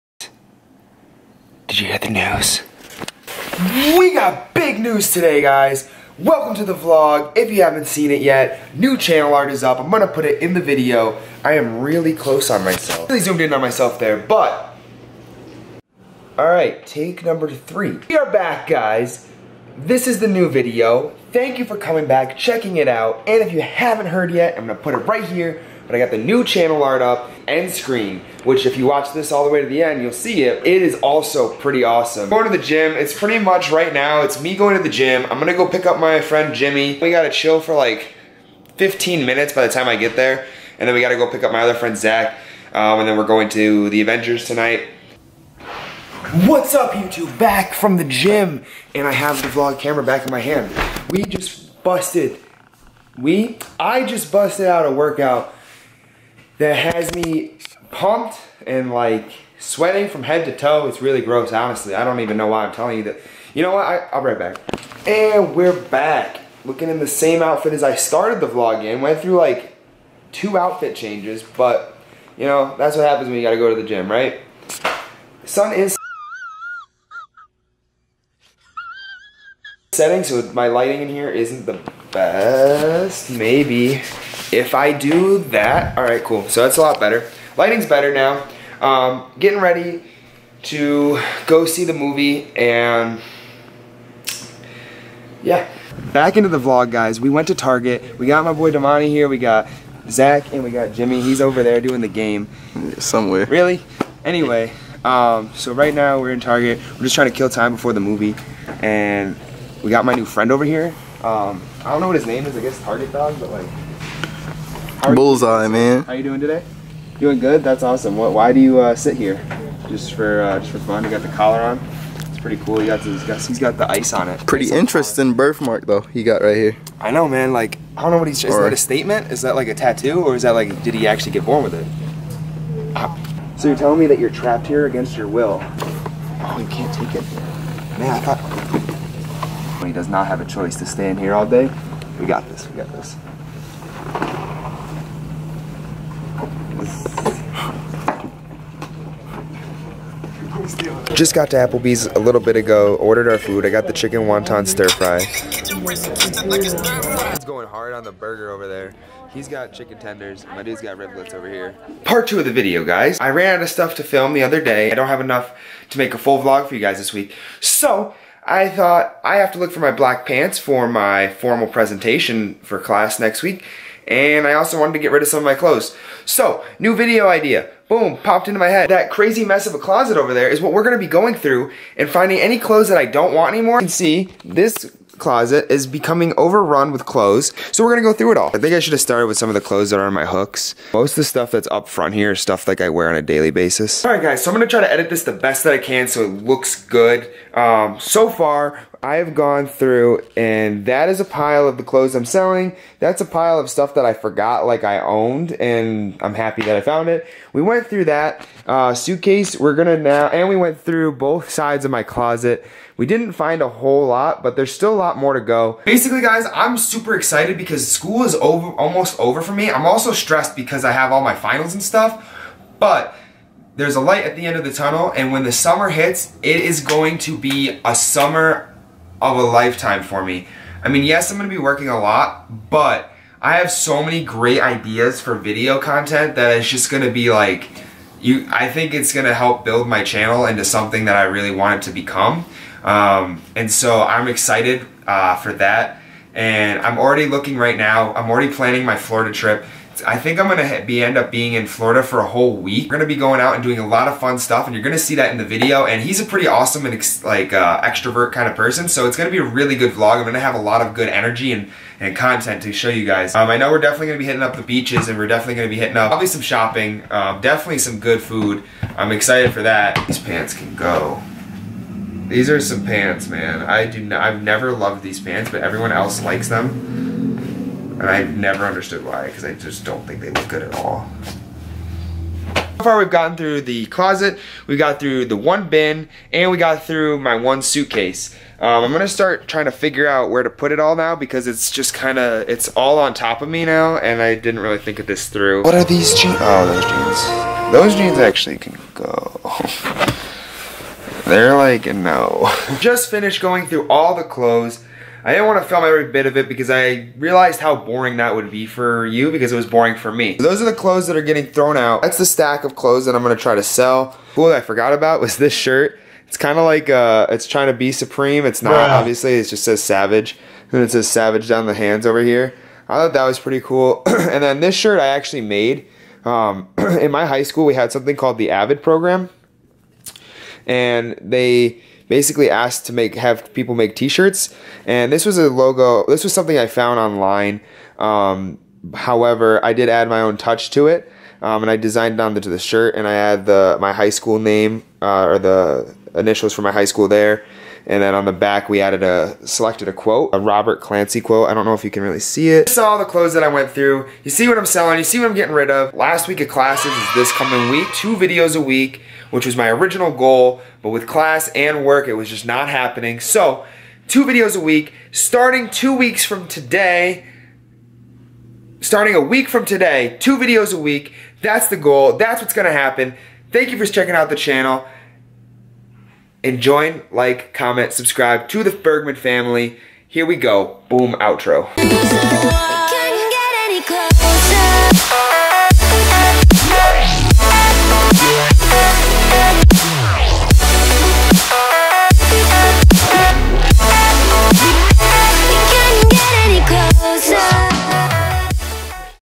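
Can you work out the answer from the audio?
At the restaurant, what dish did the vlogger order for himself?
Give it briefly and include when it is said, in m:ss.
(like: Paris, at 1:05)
Chicken wonton stir fry, at 2:33.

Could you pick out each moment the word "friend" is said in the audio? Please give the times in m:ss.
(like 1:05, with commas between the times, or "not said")
0:36, 0:41, 1:50.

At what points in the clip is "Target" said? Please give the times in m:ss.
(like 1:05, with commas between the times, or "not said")
1:37, 1:46, 1:52.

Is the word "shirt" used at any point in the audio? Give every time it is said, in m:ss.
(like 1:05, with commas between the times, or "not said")
5:15, 5:24, 5:33, 5:42.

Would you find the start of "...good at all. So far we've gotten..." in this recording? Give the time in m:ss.
4:40.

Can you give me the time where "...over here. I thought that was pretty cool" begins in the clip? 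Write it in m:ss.
5:22.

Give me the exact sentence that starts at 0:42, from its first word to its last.
Um, and then we're going to the Avengers tonight.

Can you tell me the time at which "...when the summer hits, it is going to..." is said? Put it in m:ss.
3:45.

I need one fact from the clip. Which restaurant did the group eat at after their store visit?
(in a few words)
Applebee's.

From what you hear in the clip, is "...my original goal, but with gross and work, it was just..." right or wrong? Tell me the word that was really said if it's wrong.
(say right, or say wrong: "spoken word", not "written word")
wrong: "class", not "gross".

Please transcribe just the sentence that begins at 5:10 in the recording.
So those are the clothes that are getting thrown out.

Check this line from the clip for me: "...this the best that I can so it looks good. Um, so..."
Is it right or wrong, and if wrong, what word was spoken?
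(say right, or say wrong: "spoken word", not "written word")
right.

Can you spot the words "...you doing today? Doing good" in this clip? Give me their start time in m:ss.
1:56.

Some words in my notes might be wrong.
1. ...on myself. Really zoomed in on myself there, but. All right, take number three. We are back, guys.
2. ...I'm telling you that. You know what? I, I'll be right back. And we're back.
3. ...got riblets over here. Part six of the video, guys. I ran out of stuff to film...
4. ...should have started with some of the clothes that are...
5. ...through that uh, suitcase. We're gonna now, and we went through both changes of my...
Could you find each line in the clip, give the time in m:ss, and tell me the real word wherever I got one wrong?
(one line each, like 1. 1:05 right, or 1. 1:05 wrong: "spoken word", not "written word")
1. 0:12 right
2. 1:02 right
3. 2:40 wrong: "two", not "six"
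4. 3:08 right
5. 3:27 wrong: "sides", not "changes".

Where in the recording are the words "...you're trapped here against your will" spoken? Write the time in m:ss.
2:14.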